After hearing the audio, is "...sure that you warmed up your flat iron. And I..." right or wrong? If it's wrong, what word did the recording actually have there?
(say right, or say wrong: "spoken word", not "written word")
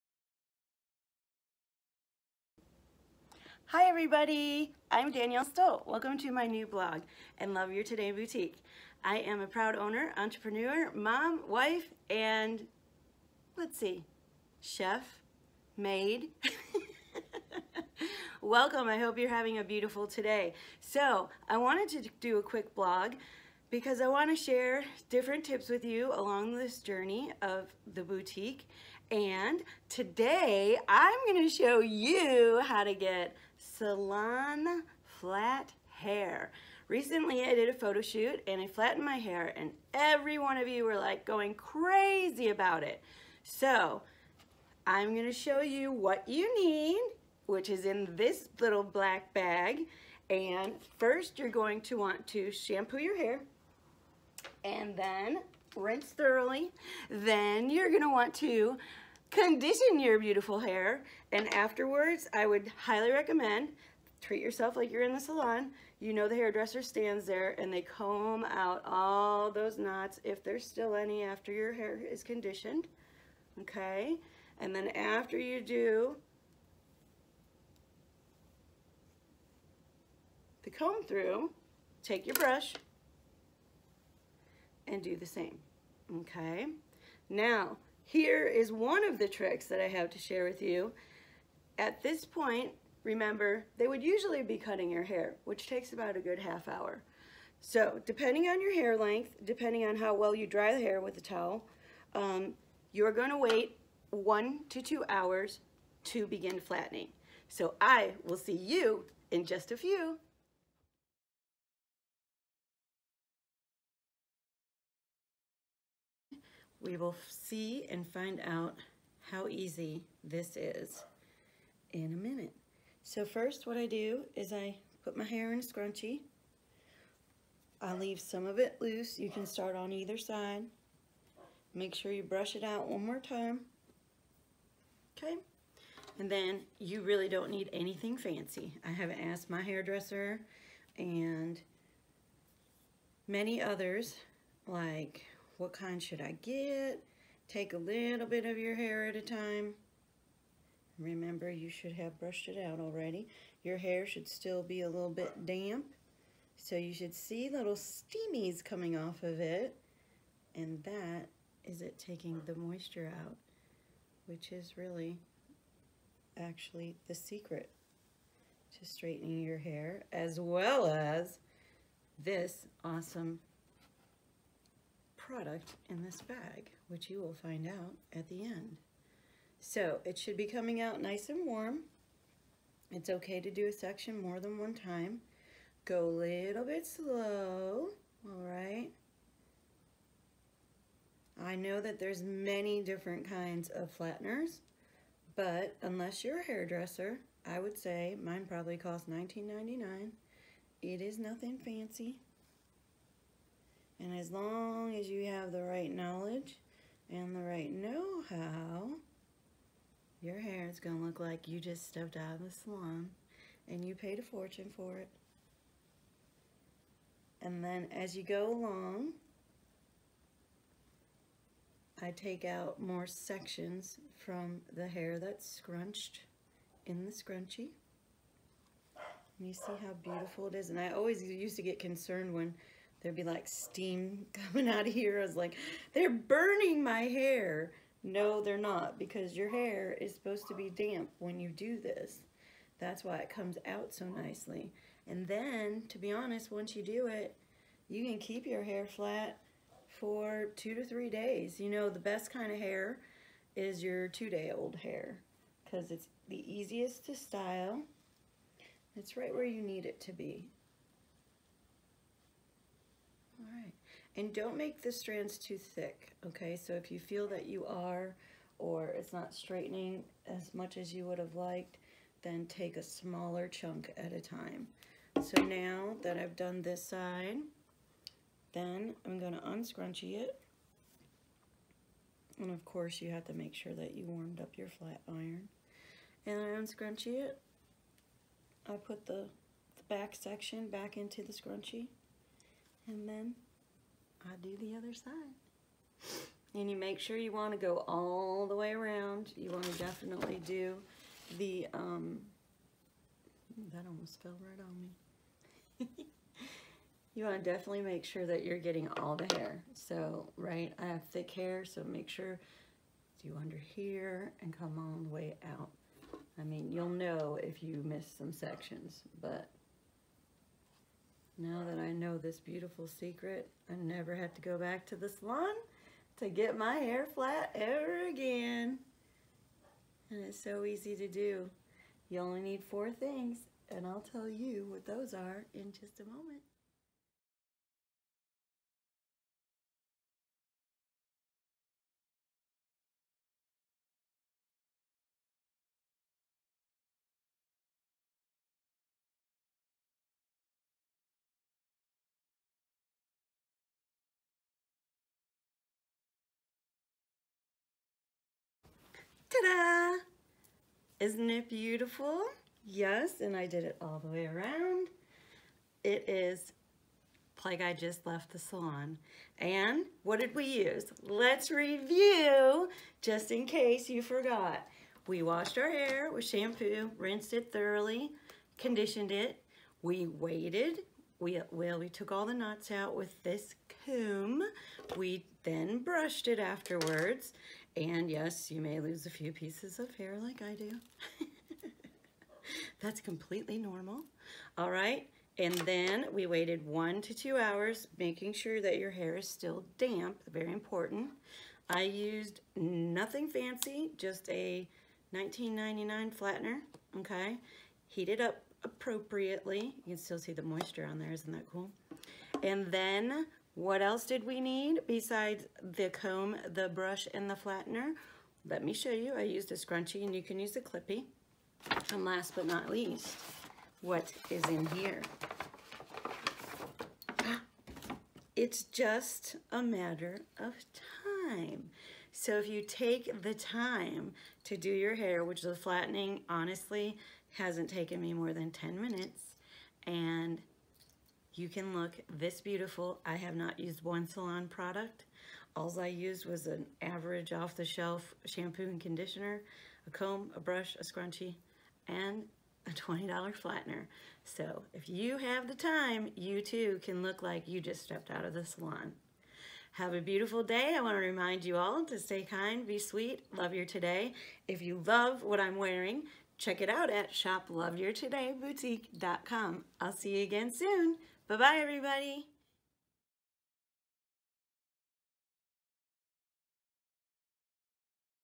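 right.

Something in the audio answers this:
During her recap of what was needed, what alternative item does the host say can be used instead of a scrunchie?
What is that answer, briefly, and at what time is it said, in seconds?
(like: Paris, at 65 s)
clippy, at 420 s.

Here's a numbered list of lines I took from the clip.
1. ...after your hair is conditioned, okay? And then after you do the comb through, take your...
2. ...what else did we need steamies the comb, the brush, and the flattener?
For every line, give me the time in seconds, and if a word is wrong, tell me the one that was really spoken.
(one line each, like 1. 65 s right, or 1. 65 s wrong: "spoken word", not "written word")
1. 71 s right
2. 413 s wrong: "besides", not "steamies".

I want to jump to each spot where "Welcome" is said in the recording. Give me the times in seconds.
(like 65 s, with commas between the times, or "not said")
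5 s, 18 s.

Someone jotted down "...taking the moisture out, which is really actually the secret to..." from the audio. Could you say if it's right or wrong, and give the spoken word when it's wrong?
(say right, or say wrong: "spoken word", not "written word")
right.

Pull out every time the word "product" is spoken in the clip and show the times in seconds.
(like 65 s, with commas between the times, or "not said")
175 s, 444 s.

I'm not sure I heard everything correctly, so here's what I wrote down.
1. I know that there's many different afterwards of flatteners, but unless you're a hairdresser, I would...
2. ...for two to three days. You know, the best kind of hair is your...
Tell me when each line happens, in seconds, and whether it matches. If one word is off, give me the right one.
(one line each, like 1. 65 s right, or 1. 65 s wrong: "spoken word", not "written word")
1. 191 s wrong: "kinds", not "afterwards"
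2. 249 s right.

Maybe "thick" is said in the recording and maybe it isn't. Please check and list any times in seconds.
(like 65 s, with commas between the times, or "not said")
265 s, 311 s.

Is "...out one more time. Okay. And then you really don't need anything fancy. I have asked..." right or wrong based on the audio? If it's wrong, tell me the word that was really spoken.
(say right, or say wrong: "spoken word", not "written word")
right.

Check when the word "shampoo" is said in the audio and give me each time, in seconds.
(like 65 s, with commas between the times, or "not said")
52 s, 376 s, 448 s.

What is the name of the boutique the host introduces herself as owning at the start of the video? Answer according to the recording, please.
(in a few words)
Love Your Today Boutique.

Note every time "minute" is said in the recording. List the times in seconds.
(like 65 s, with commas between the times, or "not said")
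122 s, 438 s.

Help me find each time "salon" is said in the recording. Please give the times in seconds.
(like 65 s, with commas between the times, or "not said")
33 s, 65 s, 212 s, 325 s, 368 s, 444 s, 458 s.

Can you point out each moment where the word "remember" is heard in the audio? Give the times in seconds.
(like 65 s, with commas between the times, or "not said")
93 s, 150 s.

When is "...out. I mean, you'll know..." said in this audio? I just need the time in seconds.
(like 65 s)
315 s.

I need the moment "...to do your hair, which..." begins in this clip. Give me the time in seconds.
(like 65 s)
434 s.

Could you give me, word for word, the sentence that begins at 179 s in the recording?
So it should be coming out nice and warm.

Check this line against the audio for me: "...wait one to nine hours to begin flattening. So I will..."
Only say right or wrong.
wrong.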